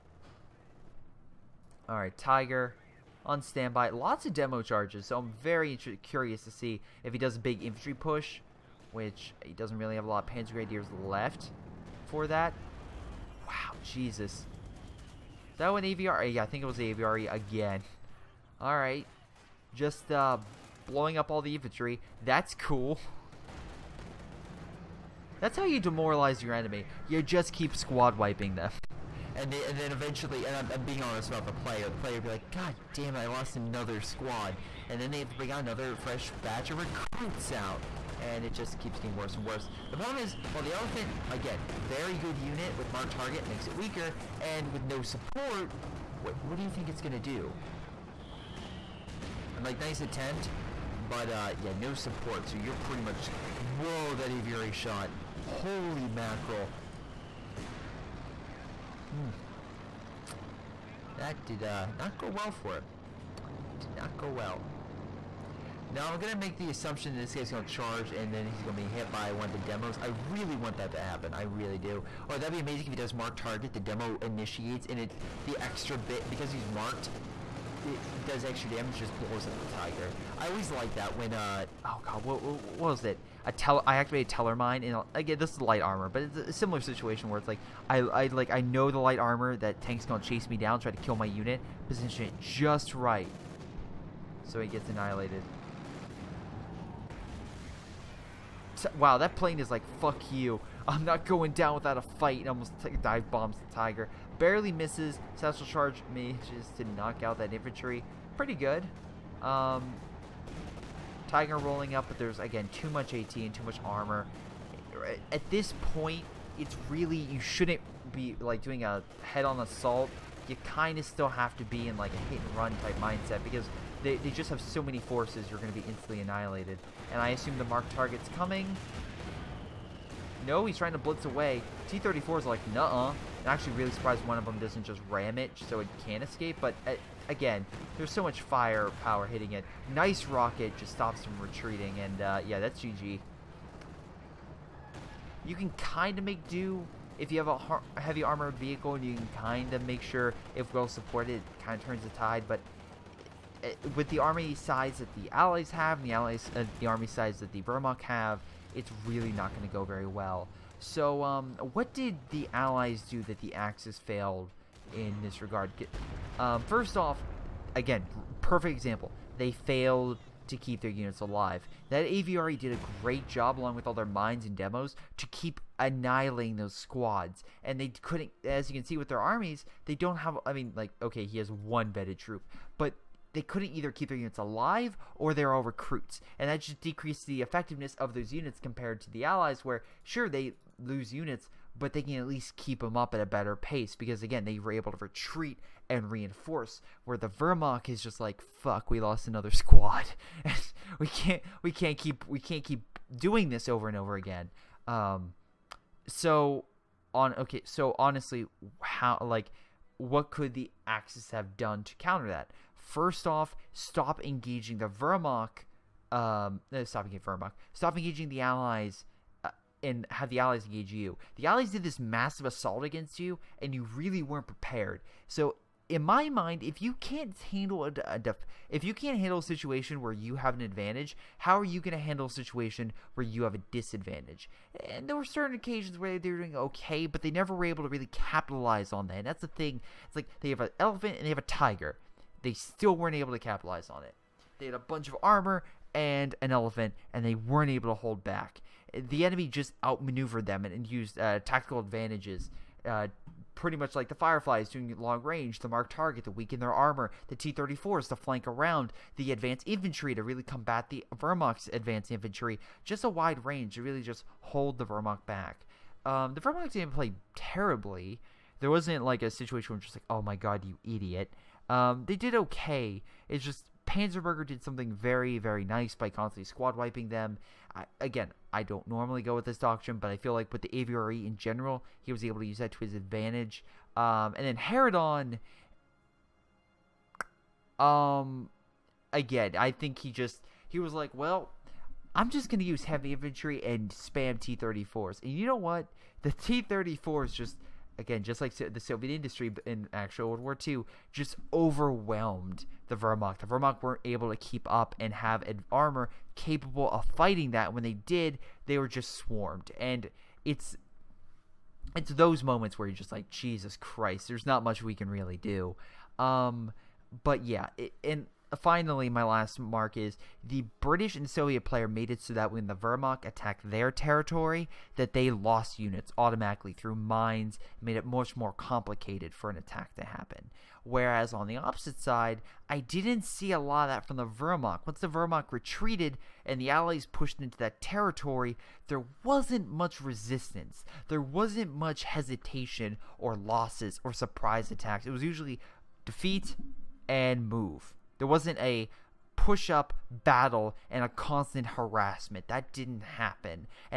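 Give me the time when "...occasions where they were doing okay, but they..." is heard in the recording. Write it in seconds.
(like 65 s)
235 s.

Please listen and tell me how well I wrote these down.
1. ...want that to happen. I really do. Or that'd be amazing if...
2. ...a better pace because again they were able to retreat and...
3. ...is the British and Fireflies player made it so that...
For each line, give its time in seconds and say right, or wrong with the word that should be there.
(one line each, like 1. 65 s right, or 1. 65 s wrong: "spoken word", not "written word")
1. 70 s right
2. 193 s right
3. 319 s wrong: "Soviet", not "Fireflies".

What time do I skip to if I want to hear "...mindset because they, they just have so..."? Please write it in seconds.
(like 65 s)
122 s.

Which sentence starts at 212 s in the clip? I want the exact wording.
First off, stop engaging the Wehrmacht.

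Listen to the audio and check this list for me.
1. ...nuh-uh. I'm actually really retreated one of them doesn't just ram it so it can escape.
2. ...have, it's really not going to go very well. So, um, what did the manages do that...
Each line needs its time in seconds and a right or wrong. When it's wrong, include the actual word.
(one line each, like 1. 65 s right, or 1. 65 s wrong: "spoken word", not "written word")
1. 132 s wrong: "surprised", not "retreated"
2. 158 s wrong: "allies", not "manages".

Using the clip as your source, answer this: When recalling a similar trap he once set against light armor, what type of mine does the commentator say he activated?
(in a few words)
Teller mine.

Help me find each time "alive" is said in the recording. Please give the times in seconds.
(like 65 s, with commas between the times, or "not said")
171 s, 184 s.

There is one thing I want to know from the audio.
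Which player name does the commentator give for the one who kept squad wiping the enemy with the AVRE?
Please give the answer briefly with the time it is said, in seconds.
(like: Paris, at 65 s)
Panzerberger, at 273 s.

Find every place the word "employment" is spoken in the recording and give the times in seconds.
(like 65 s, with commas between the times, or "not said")
not said.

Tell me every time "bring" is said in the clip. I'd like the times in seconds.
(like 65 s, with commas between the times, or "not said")
35 s.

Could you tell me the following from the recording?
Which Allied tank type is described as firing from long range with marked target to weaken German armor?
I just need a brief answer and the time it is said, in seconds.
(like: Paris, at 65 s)
Fireflies, at 254 s.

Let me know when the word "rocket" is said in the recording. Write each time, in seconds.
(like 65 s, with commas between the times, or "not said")
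140 s.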